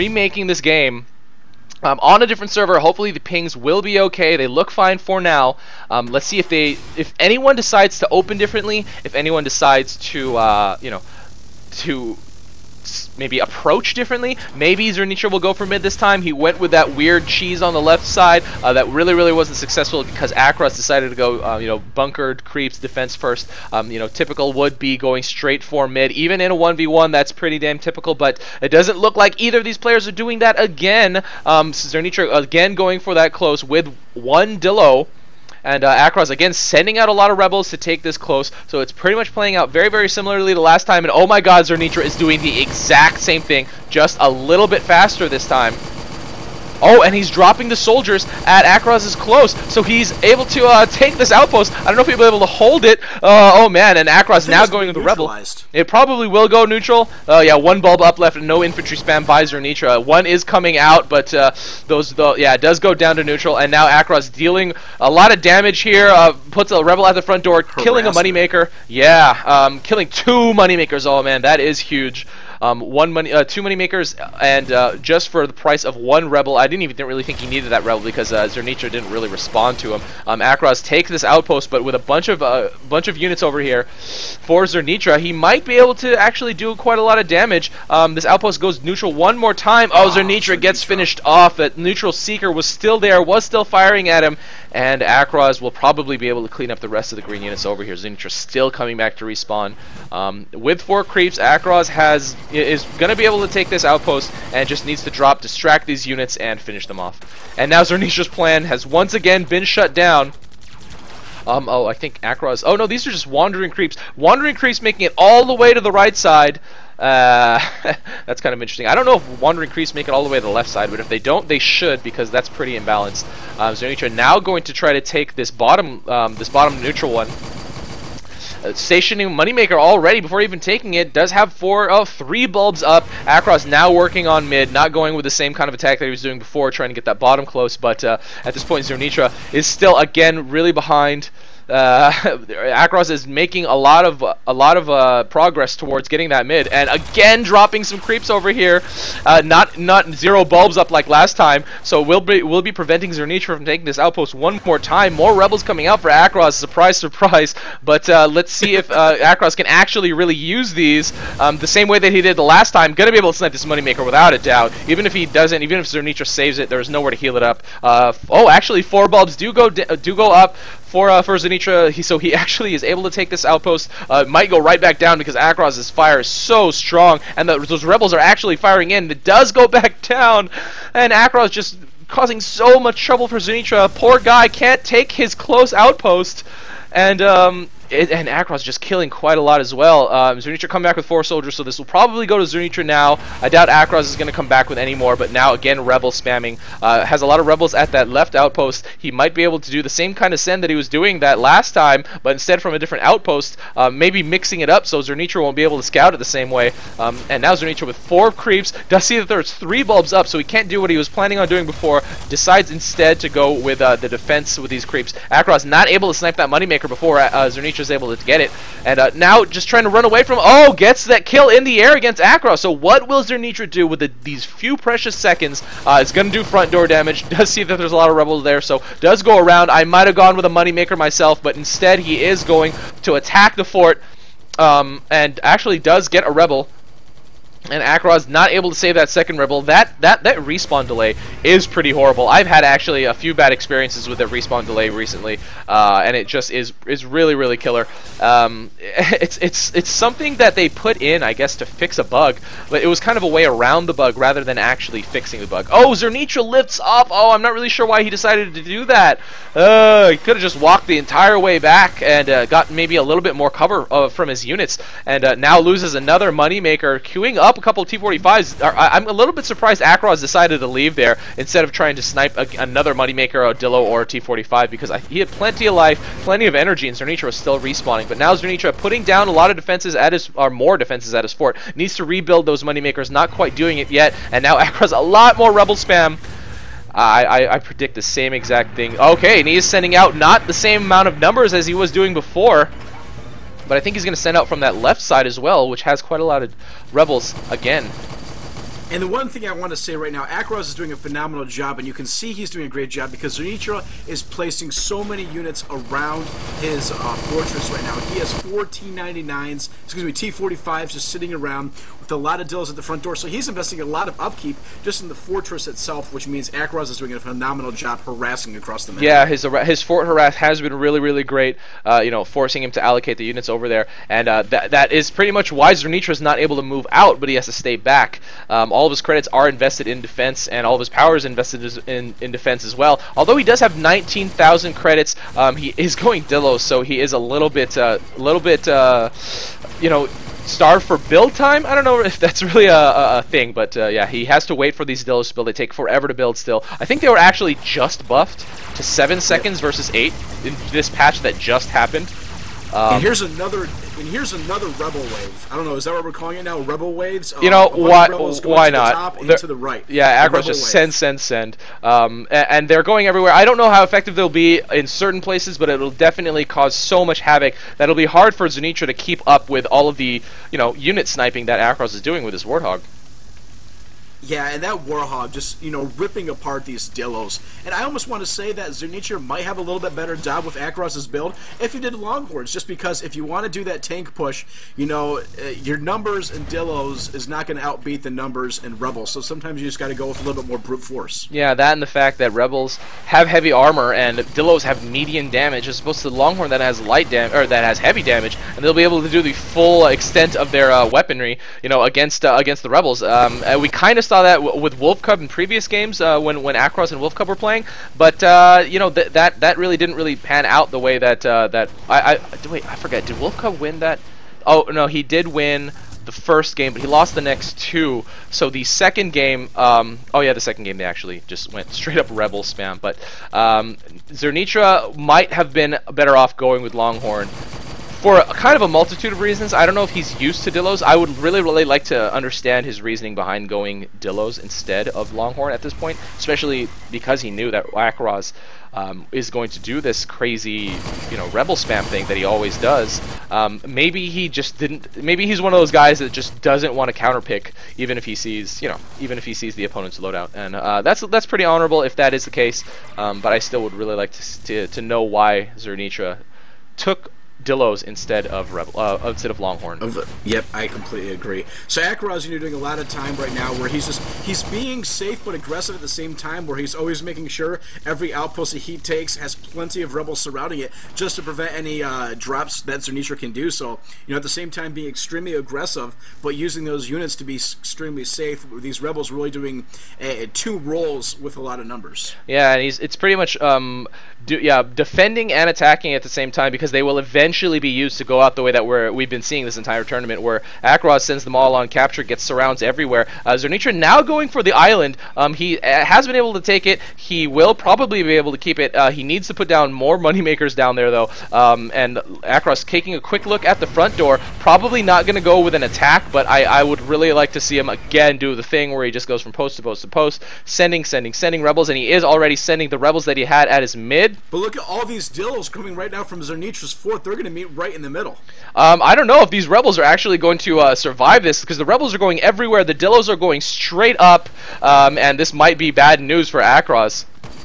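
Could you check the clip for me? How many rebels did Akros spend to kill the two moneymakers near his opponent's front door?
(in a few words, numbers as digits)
1.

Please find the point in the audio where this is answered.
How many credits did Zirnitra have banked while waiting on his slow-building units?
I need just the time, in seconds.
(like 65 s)
333 s.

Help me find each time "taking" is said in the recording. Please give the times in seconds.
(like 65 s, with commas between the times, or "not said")
130 s, 153 s, 502 s.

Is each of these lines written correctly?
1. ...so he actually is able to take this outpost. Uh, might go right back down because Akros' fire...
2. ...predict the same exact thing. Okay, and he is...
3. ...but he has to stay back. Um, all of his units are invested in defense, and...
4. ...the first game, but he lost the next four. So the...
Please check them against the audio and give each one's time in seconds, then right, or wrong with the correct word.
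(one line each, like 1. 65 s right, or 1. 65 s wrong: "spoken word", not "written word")
1. 172 s right
2. 287 s right
3. 327 s wrong: "credits", not "units"
4. 416 s wrong: "two", not "four".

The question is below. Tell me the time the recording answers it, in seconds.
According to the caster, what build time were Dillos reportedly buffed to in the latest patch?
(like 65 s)
348 s.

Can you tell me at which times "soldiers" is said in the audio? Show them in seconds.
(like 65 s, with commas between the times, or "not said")
47 s, 191 s.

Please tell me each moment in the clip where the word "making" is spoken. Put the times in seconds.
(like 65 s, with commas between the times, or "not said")
114 s, 143 s, 467 s.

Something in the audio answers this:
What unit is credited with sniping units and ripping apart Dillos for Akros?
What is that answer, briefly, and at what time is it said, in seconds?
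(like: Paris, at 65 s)
Warthog, at 372 s.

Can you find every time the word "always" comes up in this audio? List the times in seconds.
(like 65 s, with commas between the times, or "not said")
442 s, 466 s.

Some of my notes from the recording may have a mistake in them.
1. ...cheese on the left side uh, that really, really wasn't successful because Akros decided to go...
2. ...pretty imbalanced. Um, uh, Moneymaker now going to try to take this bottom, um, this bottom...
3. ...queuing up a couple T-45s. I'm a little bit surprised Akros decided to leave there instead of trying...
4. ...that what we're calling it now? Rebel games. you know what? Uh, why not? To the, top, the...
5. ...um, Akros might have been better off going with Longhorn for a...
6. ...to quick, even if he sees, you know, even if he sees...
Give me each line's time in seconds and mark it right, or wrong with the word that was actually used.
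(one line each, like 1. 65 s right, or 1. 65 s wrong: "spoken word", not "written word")
1. 17 s right
2. 122 s wrong: "Zirnitra", not "Moneymaker"
3. 267 s right
4. 355 s wrong: "waves", not "games"
5. 423 s wrong: "Zirnitra", not "Akros"
6. 446 s wrong: "counterpick", not "quick".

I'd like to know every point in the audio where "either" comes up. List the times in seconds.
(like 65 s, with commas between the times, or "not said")
29 s.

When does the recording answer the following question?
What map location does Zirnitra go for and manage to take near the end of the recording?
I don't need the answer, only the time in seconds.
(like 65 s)
494 s.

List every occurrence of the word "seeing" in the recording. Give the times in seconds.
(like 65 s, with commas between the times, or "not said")
489 s.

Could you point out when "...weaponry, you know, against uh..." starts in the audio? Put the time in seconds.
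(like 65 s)
400 s.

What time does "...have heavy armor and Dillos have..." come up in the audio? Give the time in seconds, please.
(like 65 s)
393 s.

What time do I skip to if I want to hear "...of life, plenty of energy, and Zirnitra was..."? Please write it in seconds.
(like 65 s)
275 s.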